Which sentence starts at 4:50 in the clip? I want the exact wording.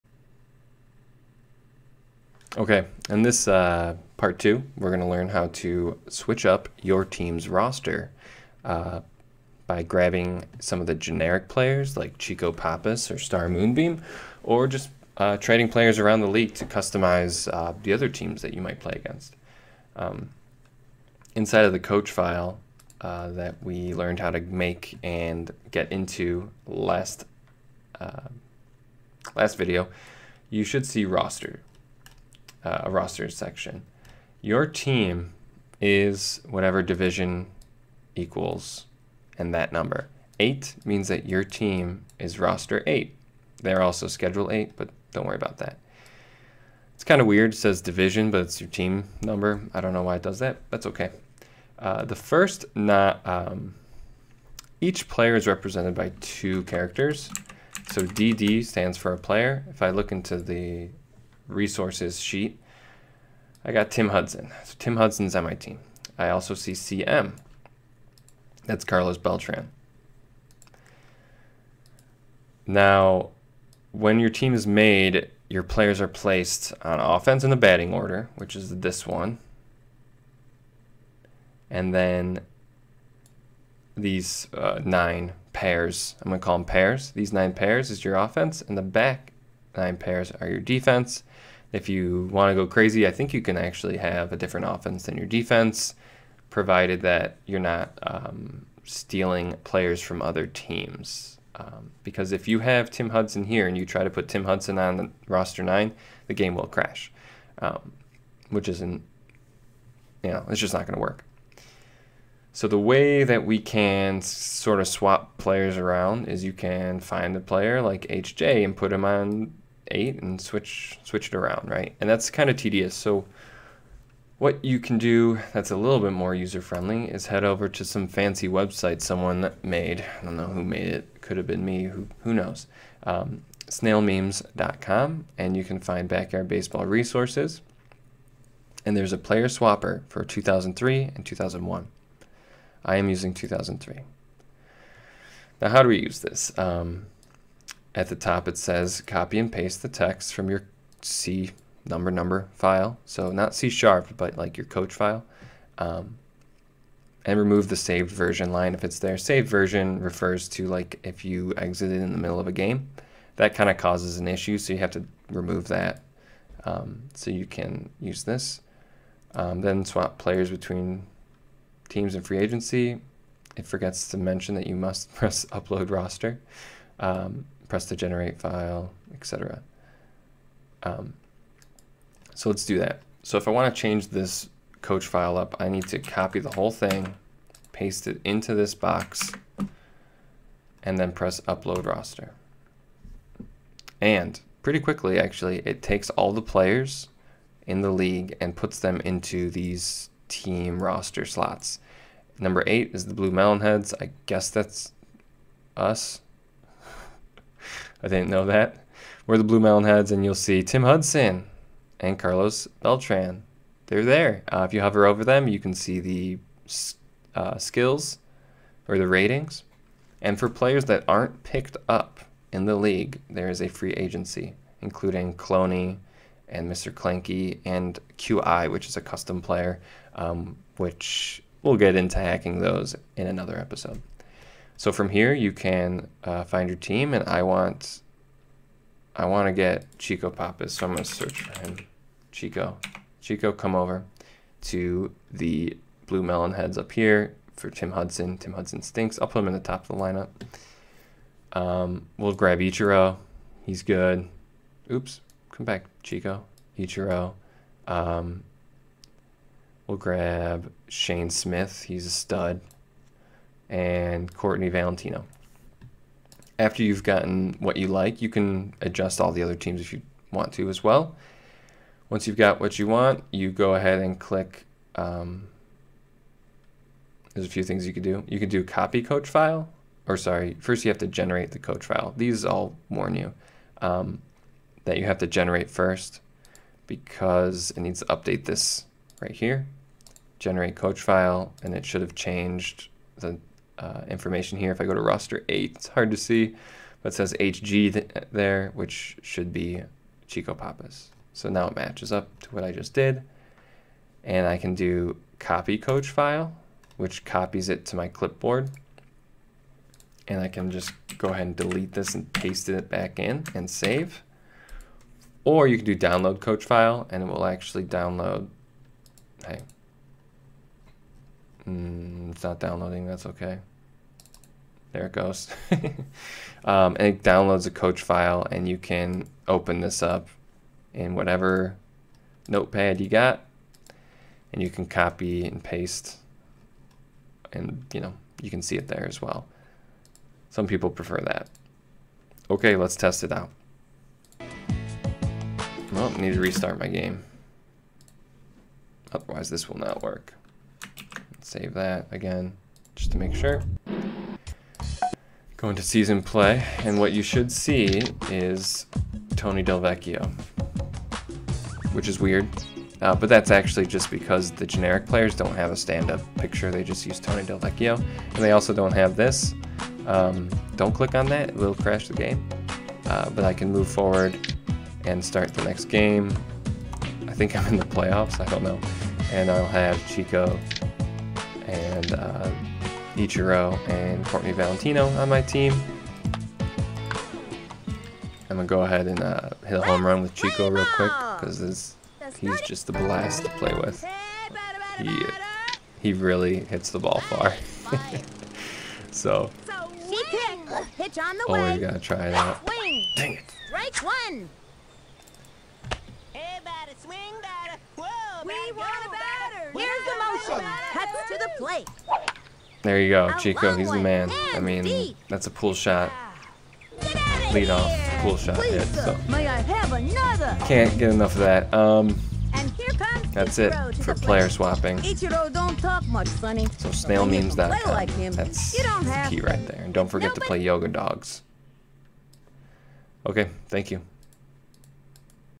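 Generate coach file, and it should have changed the uh, information here.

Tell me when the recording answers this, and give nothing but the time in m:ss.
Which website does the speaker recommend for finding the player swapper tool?
2:13.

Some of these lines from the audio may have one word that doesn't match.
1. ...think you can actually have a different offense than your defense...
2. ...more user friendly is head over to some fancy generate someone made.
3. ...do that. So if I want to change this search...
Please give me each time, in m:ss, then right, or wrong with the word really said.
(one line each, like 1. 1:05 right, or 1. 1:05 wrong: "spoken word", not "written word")
1. 1:33 right
2. 2:06 wrong: "website", not "generate"
3. 3:02 wrong: "coach", not "search".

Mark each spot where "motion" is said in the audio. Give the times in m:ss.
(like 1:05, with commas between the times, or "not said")
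6:50.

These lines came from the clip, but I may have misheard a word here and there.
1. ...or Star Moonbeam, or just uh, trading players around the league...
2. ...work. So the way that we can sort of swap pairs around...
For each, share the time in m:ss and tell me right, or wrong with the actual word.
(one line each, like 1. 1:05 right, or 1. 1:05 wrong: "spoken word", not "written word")
1. 0:13 right
2. 1:51 wrong: "players", not "pairs".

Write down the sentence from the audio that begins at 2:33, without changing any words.
So not C sharp, but like your coach file.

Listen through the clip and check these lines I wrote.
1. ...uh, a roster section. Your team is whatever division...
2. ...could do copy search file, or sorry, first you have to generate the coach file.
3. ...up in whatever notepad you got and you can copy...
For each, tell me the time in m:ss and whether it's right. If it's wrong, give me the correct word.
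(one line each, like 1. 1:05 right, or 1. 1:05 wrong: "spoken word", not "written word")
1. 0:32 right
2. 4:38 wrong: "coach", not "search"
3. 5:30 right.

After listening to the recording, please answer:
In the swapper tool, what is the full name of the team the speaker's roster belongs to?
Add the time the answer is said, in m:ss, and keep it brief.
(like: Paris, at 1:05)
Blue Mountain Heads, at 3:29.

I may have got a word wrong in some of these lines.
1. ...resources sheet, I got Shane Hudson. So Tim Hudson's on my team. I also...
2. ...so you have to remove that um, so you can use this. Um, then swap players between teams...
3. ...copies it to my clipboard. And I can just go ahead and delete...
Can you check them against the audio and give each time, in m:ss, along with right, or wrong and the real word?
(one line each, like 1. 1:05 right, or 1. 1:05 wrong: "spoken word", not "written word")
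1. 1:01 wrong: "Tim", not "Shane"
2. 2:44 right
3. 5:07 right.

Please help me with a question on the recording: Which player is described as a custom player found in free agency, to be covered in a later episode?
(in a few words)
QI.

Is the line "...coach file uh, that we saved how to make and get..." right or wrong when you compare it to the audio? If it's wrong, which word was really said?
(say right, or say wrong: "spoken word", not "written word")
wrong: "learned", not "saved".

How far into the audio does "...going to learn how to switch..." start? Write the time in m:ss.
0:04.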